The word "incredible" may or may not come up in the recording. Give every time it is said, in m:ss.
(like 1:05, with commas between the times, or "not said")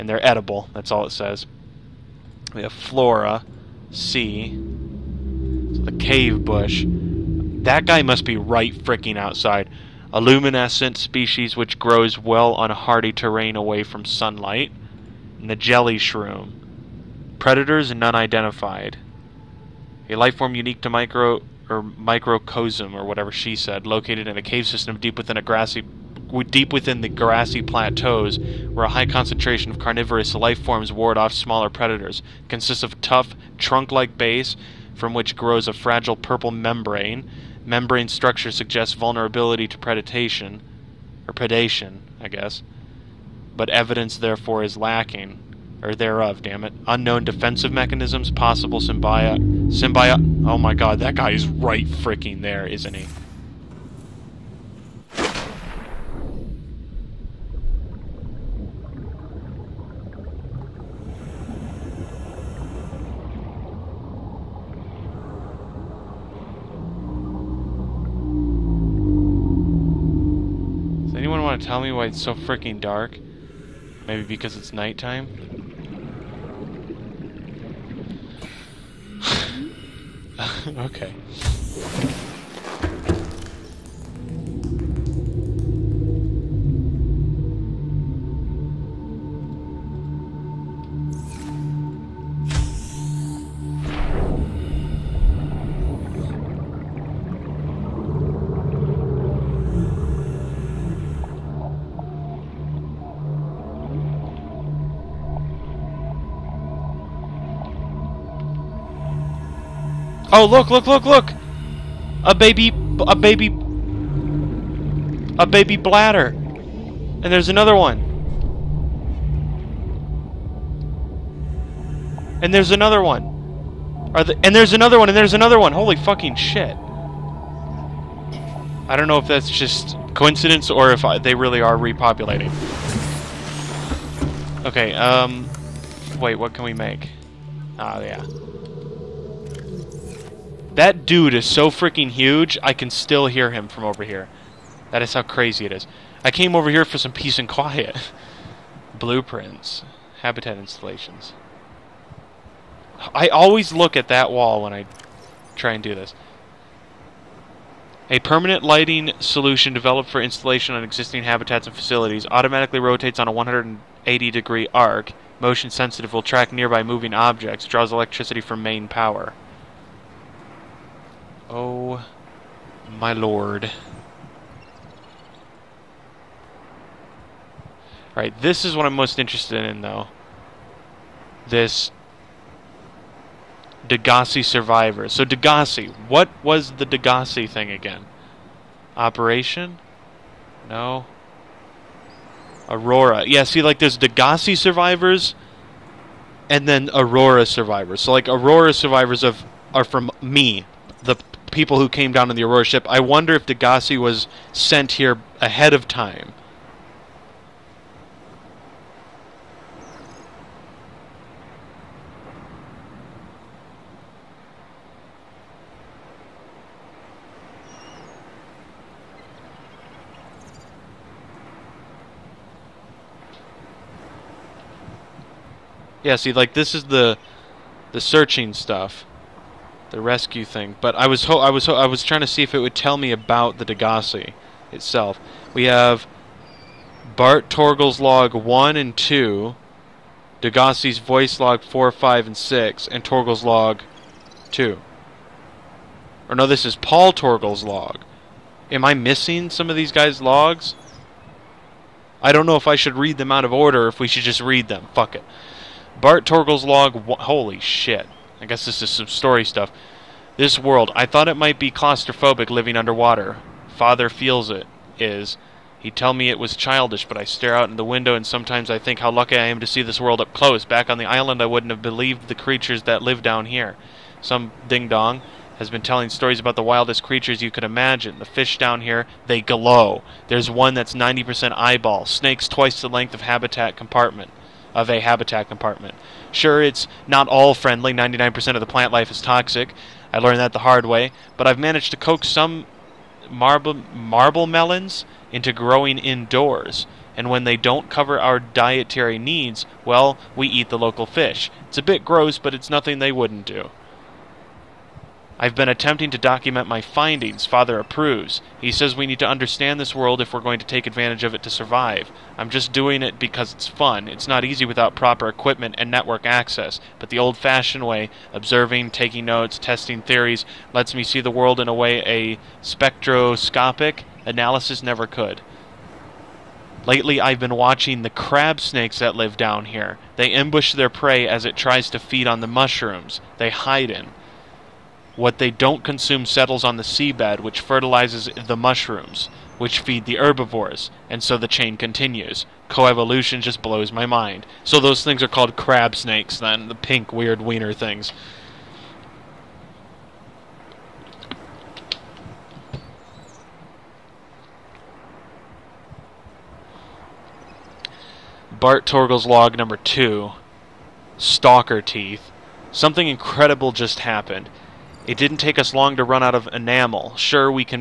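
6:03.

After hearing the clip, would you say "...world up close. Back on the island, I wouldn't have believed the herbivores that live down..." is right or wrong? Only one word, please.
wrong.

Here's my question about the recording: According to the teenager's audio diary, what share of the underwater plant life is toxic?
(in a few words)
99%.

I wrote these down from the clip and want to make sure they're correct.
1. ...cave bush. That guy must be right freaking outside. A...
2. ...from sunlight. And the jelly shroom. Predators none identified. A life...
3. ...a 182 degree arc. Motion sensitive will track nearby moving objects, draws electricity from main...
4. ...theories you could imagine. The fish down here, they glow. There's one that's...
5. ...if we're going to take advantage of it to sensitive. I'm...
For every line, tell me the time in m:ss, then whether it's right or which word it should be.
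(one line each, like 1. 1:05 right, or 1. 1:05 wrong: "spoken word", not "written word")
1. 0:05 right
2. 0:13 right
3. 2:43 wrong: "180", not "182"
4. 4:37 wrong: "creatures", not "theories"
5. 5:10 wrong: "survive", not "sensitive".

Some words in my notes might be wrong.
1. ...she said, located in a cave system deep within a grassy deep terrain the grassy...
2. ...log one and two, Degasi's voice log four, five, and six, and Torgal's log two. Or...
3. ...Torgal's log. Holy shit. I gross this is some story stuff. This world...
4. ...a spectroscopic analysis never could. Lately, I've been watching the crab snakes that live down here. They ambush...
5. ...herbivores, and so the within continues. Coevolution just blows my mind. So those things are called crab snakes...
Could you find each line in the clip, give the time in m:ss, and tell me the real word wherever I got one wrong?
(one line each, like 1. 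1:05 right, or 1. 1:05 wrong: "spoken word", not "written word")
1. 0:23 wrong: "within", not "terrain"
2. 3:58 right
3. 4:16 wrong: "guess", not "gross"
4. 5:22 right
5. 5:40 wrong: "chain", not "within".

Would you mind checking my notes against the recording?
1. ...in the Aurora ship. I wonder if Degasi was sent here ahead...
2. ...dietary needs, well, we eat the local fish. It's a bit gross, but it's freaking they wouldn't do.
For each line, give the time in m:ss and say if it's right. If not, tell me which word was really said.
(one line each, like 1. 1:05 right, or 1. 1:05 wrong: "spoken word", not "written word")
1. 3:22 right
2. 4:58 wrong: "nothing", not "freaking".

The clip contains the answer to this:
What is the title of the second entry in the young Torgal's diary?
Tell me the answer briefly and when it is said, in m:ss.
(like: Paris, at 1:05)
Stalker Teeth, at 6:01.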